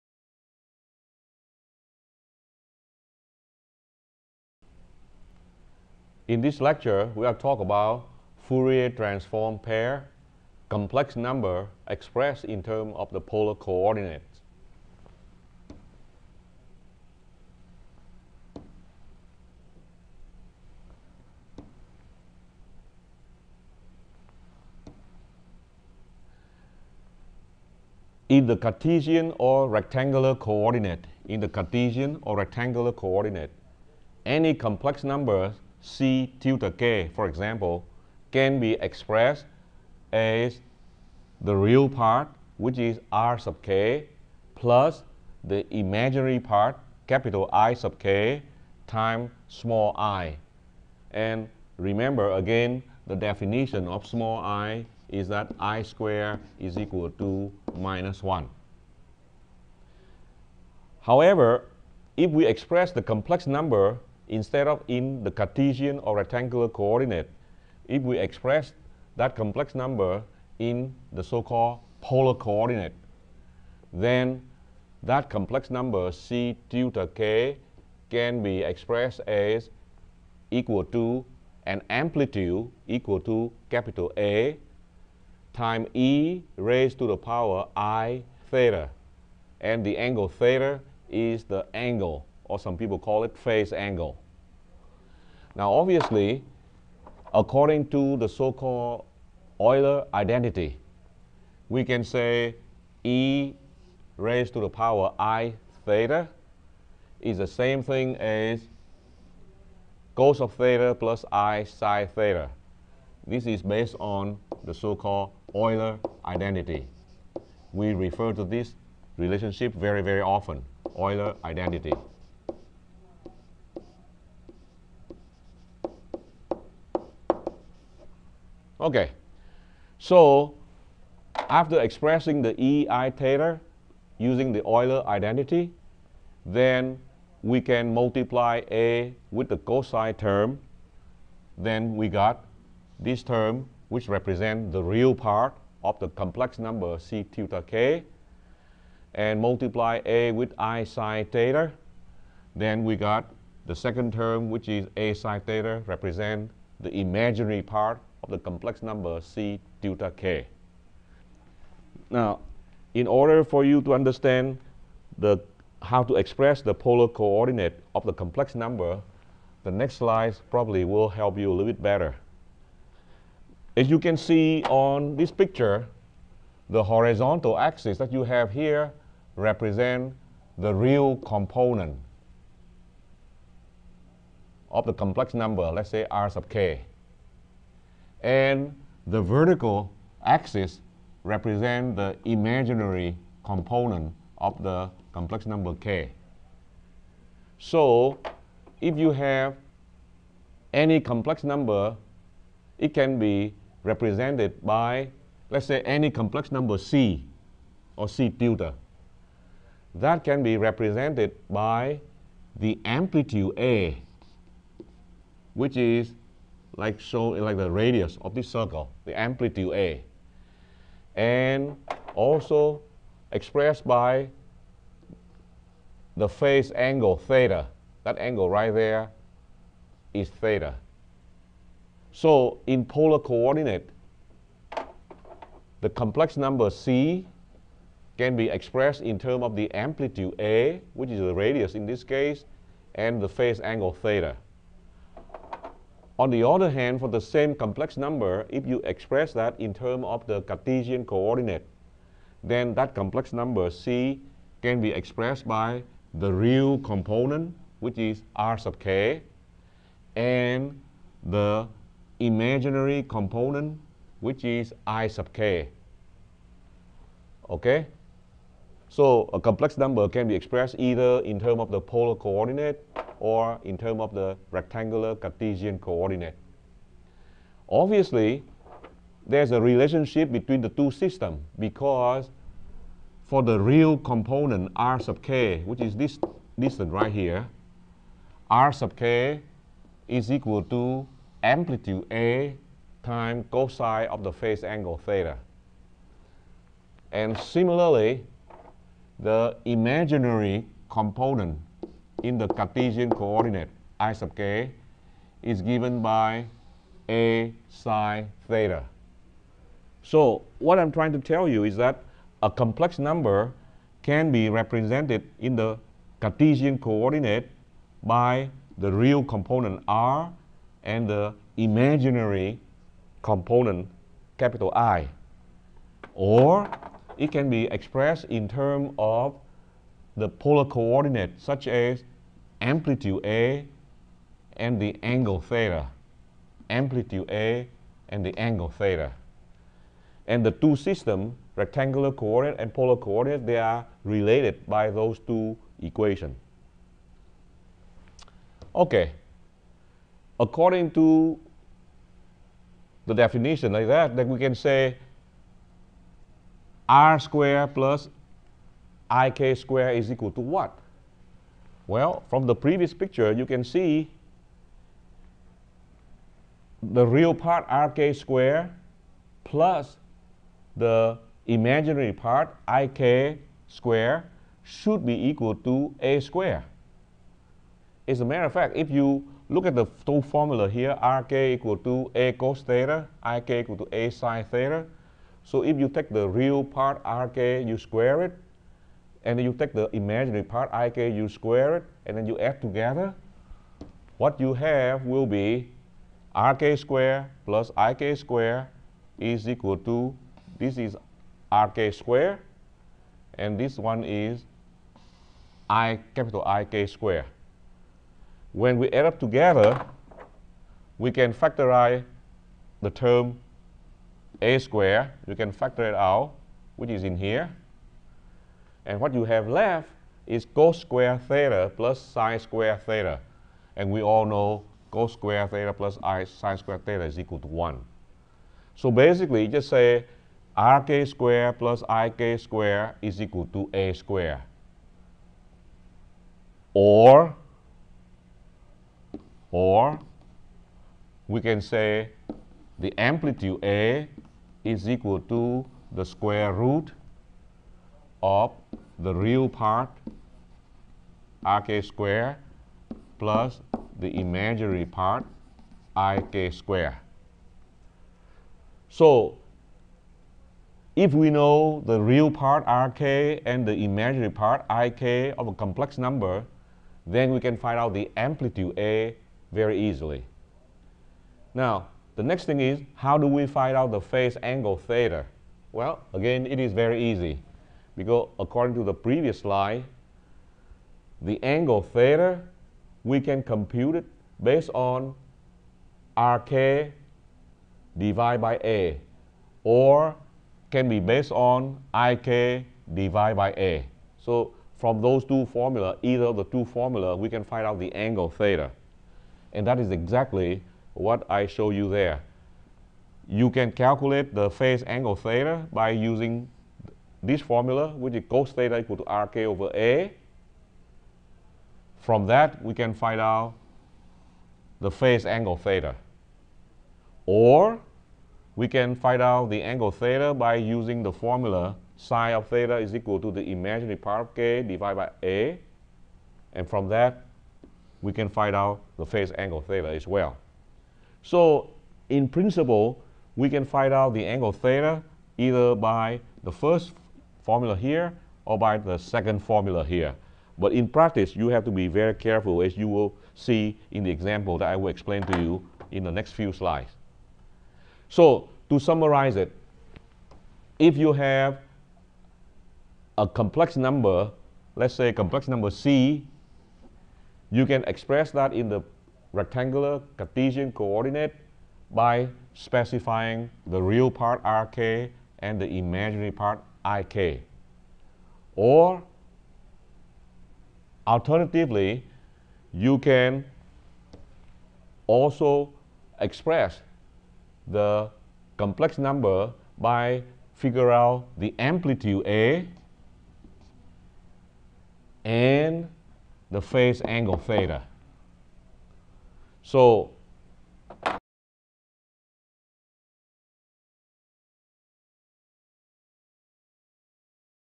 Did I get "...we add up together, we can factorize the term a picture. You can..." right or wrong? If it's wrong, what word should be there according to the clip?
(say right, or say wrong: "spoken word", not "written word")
wrong: "square", not "picture".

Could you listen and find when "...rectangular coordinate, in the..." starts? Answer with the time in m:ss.
0:29.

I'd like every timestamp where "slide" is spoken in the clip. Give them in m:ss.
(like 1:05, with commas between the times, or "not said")
2:49, 7:59, 9:06.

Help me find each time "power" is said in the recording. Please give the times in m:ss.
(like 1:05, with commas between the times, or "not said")
1:27, 1:44.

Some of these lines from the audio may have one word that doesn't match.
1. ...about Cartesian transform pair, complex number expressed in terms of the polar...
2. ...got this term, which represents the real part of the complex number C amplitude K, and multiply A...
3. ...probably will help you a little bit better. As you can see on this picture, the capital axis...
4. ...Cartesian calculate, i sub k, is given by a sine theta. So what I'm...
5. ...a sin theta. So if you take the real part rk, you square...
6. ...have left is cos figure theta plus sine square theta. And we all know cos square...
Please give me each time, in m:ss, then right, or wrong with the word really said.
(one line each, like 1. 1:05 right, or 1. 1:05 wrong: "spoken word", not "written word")
1. 0:07 wrong: "Fourier", not "Cartesian"
2. 2:22 wrong: "tilde", not "amplitude"
3. 2:50 wrong: "horizontal", not "capital"
4. 5:02 wrong: "coordinate", not "calculate"
5. 6:23 right
6. 6:59 wrong: "square", not "figure".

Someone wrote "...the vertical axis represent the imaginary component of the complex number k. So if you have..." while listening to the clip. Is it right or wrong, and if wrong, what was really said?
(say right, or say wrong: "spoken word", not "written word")
right.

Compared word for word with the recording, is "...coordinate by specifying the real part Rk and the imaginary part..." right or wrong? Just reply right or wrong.
right.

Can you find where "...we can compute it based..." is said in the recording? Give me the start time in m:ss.
8:03.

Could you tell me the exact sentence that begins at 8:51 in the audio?
So in principle, we can find out the angle theta either by the first formula here or by the second formula here.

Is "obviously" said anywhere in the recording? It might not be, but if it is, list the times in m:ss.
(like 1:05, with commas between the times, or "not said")
1:35, 4:37.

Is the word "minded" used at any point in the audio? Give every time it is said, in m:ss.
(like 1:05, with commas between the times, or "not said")
not said.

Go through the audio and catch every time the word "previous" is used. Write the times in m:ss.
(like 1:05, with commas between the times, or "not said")
6:02, 7:58.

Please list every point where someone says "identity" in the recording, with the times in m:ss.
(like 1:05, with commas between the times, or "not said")
1:40, 1:56, 2:01, 2:15.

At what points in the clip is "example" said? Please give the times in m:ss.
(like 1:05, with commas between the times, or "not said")
0:37, 9:04.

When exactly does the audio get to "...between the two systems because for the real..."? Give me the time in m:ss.
4:40.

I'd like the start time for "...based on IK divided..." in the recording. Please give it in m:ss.
8:10.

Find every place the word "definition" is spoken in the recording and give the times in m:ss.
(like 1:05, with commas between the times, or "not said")
0:53, 5:53.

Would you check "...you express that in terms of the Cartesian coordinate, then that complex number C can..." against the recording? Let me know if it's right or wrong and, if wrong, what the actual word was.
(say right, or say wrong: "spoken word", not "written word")
right.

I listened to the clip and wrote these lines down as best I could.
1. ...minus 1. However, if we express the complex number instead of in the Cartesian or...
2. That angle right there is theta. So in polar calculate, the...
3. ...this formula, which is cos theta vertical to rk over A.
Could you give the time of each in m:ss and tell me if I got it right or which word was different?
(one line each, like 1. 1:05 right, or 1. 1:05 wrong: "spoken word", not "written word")
1. 0:57 right
2. 3:48 wrong: "coordinate", not "calculate"
3. 8:27 wrong: "equal", not "vertical".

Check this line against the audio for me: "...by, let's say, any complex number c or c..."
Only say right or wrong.
right.